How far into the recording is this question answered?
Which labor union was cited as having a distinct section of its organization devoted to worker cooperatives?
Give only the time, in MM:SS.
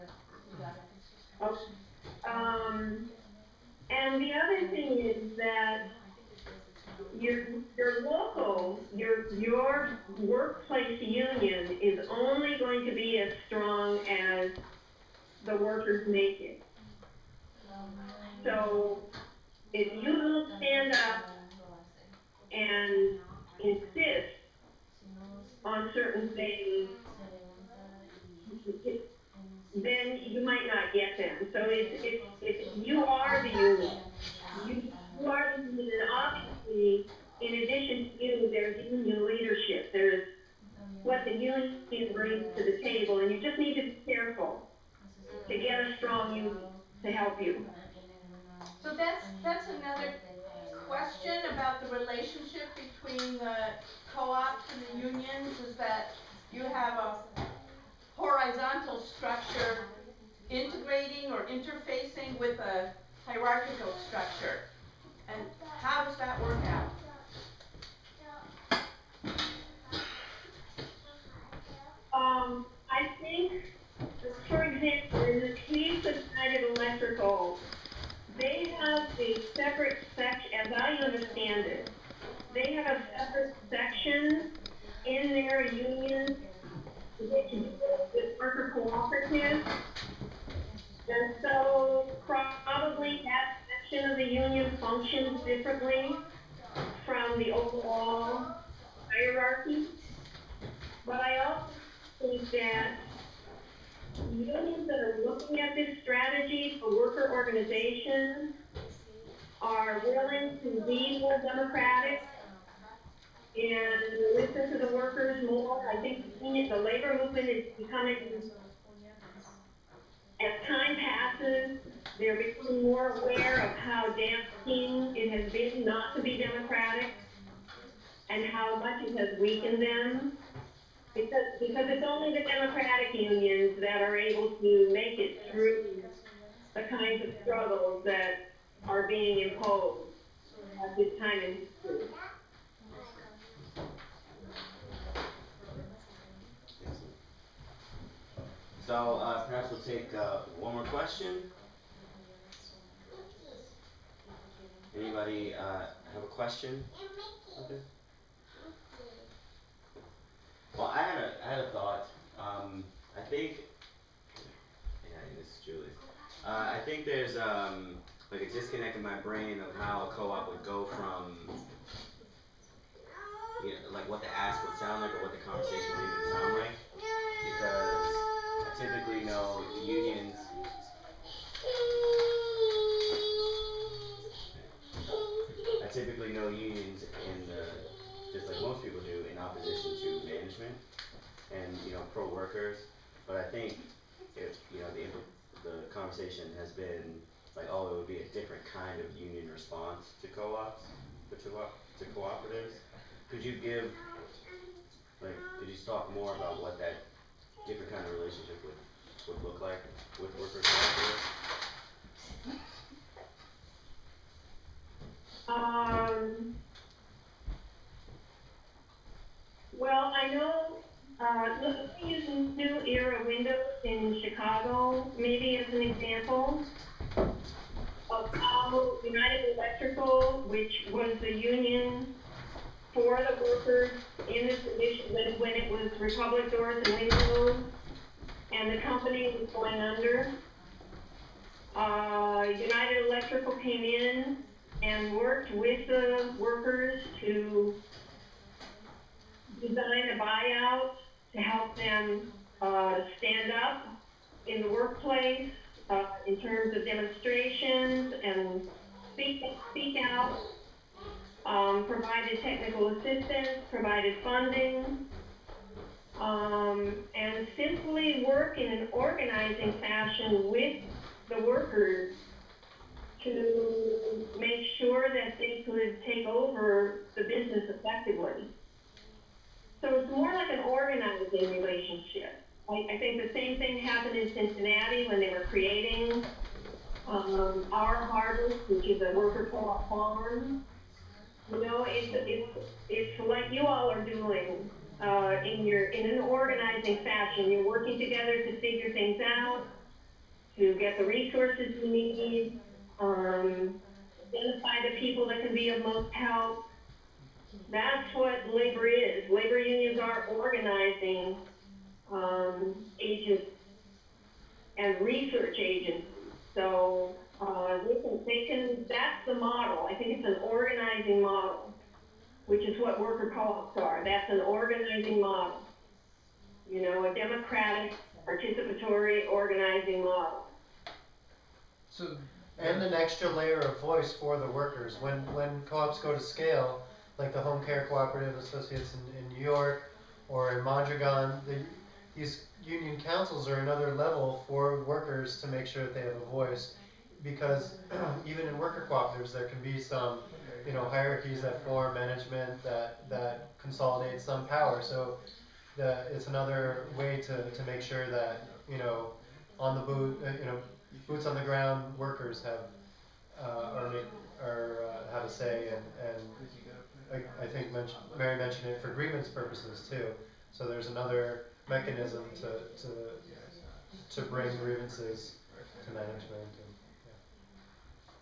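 01:16.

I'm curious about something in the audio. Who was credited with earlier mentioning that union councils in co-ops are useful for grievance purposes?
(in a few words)
Mary.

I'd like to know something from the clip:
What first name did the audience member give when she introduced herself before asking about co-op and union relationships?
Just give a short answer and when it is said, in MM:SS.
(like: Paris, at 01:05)
Julie, at 02:45.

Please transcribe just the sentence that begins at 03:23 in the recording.
Could you give like could you talk more about what that different kind of relationship would would look like with workers cooperatives?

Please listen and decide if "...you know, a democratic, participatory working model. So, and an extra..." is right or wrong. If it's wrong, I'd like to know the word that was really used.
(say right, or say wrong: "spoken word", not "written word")
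wrong: "organizing", not "working".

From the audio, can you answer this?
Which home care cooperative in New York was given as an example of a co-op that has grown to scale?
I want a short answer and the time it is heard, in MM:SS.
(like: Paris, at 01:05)
Home Care Cooperative Associates, at 05:37.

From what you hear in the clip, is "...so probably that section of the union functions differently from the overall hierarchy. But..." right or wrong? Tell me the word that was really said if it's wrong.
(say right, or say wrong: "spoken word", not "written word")
right.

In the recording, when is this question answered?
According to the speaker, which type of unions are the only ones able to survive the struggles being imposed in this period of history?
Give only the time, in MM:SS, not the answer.
02:12.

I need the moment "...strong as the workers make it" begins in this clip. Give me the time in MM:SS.
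00:13.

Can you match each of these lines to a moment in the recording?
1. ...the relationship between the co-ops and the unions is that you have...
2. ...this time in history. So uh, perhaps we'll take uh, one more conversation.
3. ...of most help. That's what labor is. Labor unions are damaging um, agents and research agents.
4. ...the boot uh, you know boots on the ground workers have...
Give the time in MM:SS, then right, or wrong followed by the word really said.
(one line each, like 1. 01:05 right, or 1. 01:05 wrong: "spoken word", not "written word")
1. 00:51 right
2. 02:20 wrong: "question", not "conversation"
3. 05:05 wrong: "organizing", not "damaging"
4. 05:59 right.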